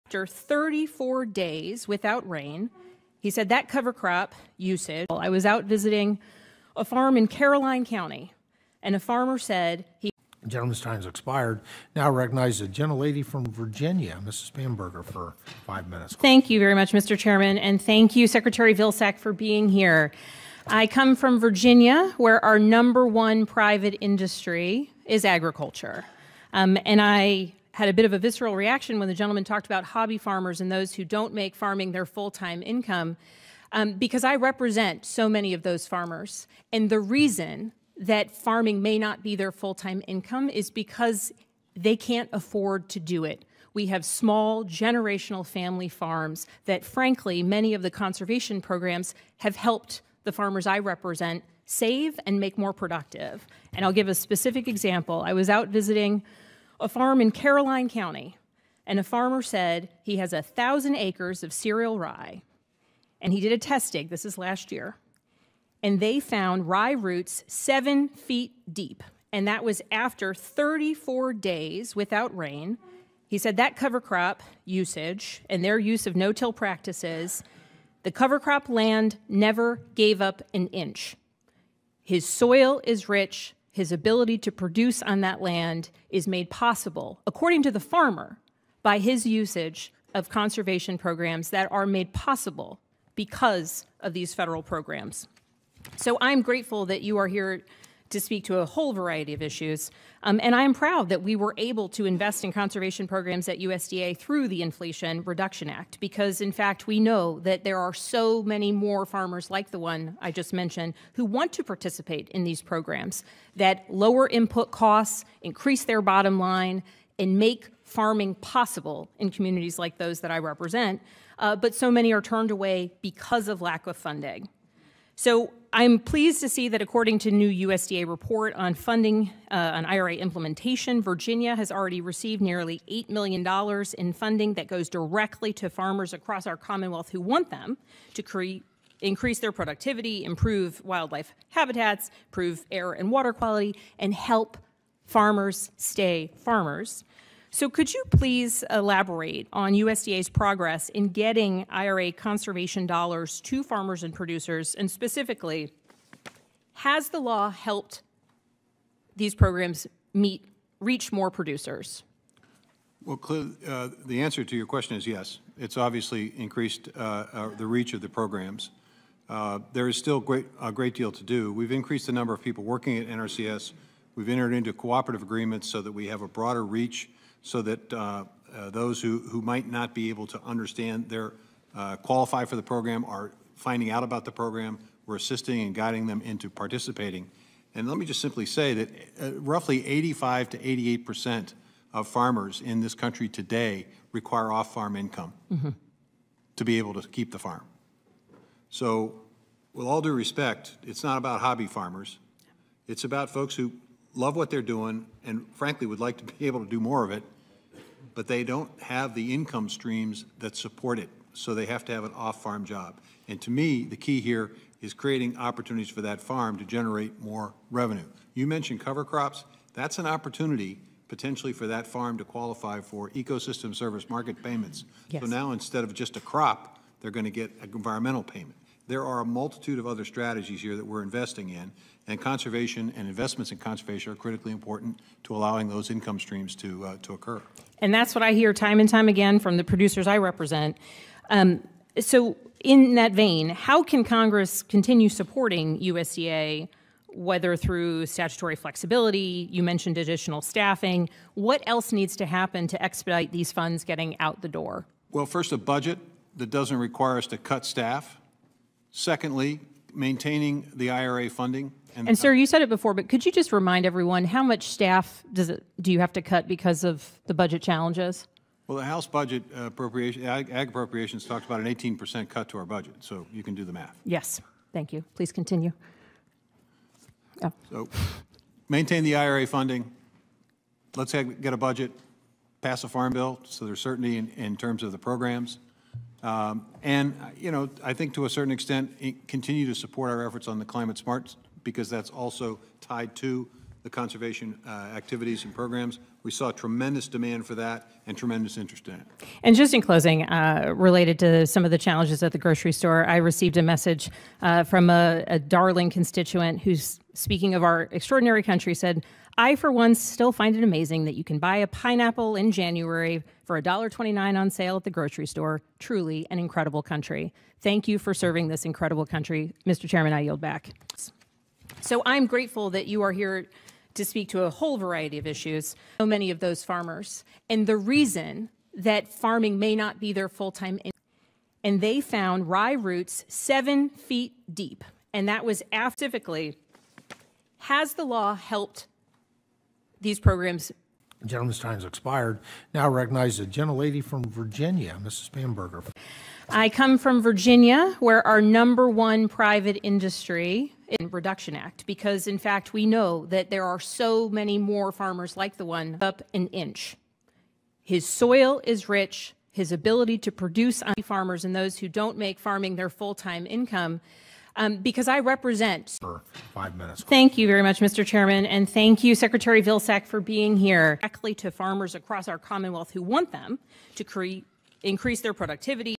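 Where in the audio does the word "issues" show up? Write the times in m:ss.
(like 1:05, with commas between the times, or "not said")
1:39, 5:25.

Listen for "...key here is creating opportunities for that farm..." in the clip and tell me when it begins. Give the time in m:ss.
3:33.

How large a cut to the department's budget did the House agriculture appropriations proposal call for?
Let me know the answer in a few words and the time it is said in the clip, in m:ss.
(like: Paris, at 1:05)
18%, at 4:31.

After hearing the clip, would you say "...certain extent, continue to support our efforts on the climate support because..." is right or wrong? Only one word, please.
wrong.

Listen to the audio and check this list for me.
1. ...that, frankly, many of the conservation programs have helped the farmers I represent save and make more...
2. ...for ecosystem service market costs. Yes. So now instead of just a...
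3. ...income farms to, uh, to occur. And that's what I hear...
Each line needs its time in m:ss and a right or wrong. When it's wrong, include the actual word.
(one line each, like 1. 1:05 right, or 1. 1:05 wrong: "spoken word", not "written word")
1. 0:46 right
2. 3:42 wrong: "payments", not "costs"
3. 3:55 wrong: "streams", not "farms".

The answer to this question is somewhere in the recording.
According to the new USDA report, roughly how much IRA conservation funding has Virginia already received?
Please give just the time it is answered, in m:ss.
2:12.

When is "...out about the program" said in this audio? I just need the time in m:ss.
3:03.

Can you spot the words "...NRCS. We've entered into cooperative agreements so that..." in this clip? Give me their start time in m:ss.
2:53.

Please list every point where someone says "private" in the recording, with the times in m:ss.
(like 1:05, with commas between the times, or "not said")
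0:23, 5:49.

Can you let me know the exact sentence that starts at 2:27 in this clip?
So, could you please elaborate on USDA's progress in getting IRA conservation dollars to farmers and producers?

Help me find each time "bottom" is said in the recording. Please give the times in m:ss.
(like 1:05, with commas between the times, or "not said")
1:56.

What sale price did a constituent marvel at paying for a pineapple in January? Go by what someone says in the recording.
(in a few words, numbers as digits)
$1.29.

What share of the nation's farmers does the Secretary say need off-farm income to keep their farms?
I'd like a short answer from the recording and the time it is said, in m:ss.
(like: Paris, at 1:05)
85 to 88 percent, at 3:09.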